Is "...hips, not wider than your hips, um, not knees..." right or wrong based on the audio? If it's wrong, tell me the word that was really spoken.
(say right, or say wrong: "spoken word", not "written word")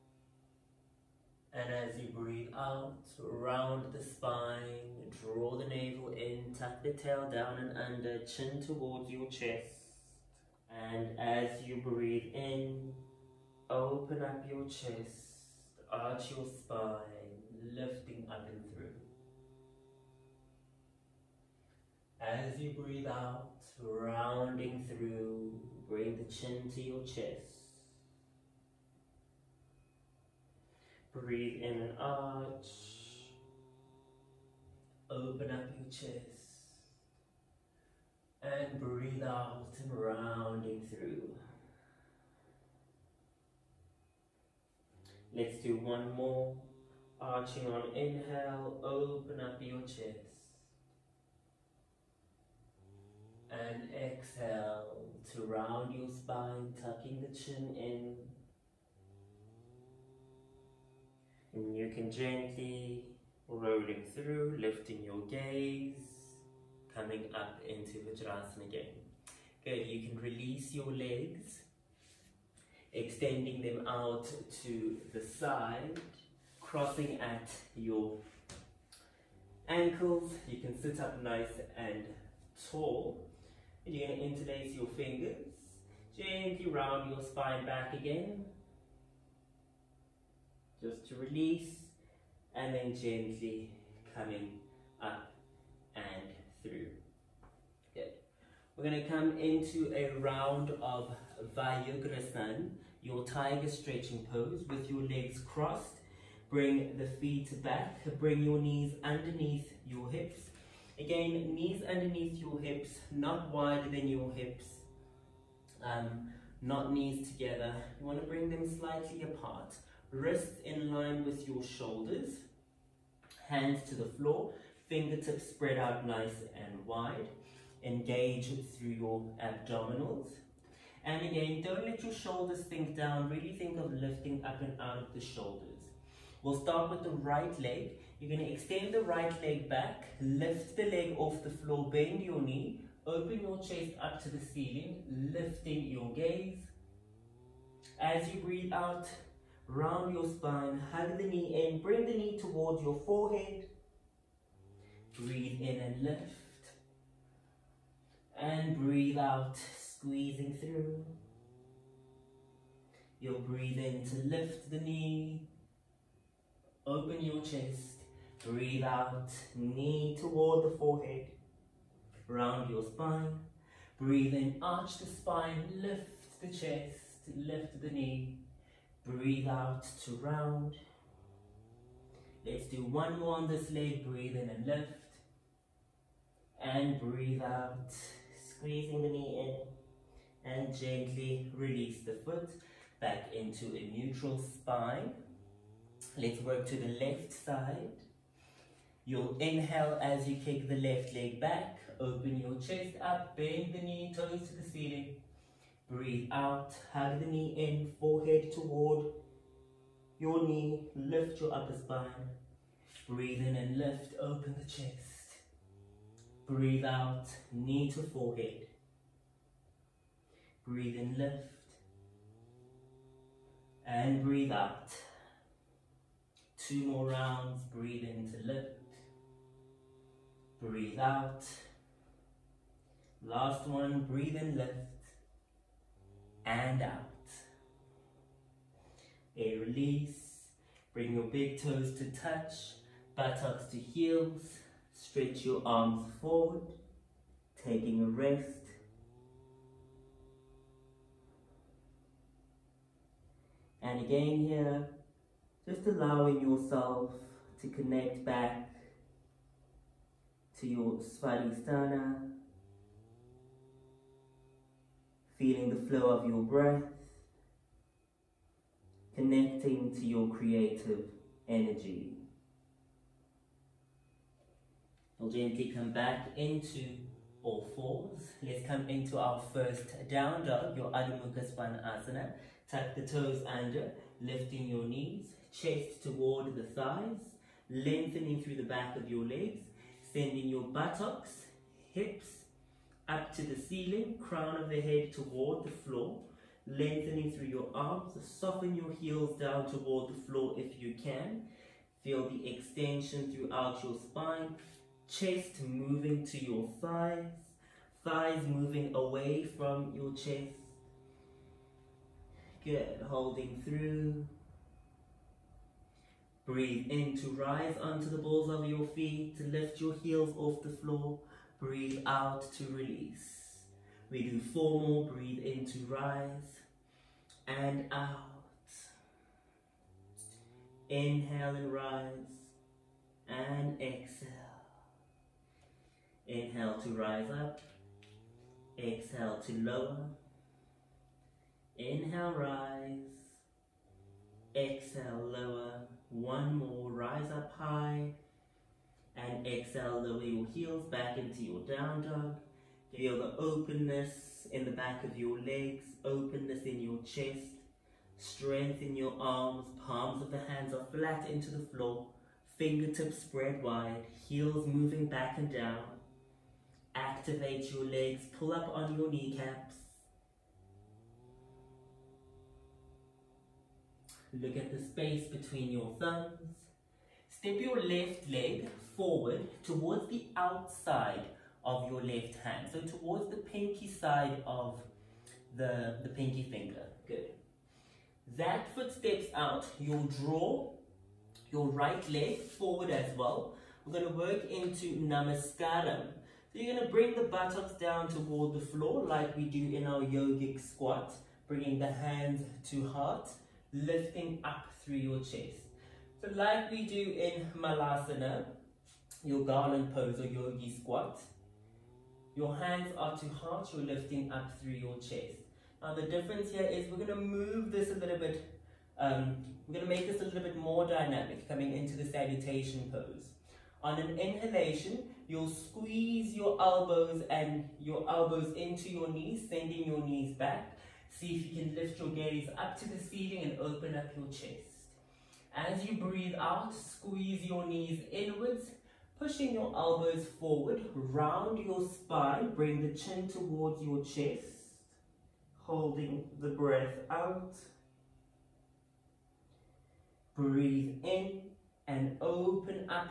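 right.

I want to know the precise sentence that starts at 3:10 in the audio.
And gently release the foot back into a neutral spine.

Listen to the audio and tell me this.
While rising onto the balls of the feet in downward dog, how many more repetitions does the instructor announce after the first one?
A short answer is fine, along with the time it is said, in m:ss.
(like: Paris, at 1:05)
4, at 5:24.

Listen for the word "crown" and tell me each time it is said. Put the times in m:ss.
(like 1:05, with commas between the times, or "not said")
4:54.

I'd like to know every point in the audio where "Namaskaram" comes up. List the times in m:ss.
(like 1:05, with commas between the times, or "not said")
6:34.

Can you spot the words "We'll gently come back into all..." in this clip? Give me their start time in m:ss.
4:35.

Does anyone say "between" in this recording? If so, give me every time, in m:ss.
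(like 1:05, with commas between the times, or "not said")
6:15.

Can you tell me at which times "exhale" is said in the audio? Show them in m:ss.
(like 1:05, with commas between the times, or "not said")
0:53, 5:33, 5:38, 5:44, 5:49.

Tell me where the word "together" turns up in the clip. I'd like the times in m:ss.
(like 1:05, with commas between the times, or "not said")
1:57.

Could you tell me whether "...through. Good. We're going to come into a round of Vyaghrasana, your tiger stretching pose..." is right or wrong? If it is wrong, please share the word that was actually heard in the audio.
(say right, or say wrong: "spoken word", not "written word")
right.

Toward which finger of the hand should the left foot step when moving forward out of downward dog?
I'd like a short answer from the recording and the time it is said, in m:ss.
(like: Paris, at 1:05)
Pinky finger, at 6:26.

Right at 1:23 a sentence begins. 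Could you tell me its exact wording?
And you're going to interlace your fingers.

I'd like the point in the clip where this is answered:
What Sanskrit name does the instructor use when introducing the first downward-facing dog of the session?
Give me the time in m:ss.
4:40.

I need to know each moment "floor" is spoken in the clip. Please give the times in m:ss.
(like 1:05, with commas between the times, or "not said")
2:04, 2:21, 4:55, 5:00, 5:20, 6:01, 6:38.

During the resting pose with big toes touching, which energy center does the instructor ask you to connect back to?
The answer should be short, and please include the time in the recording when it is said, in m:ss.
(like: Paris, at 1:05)
Svadhisthana, at 4:20.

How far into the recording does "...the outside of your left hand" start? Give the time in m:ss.
6:20.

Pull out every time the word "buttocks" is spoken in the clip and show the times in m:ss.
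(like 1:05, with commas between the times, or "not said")
4:03, 4:50, 6:37.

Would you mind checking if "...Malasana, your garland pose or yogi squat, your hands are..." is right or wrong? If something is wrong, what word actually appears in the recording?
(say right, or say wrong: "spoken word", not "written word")
right.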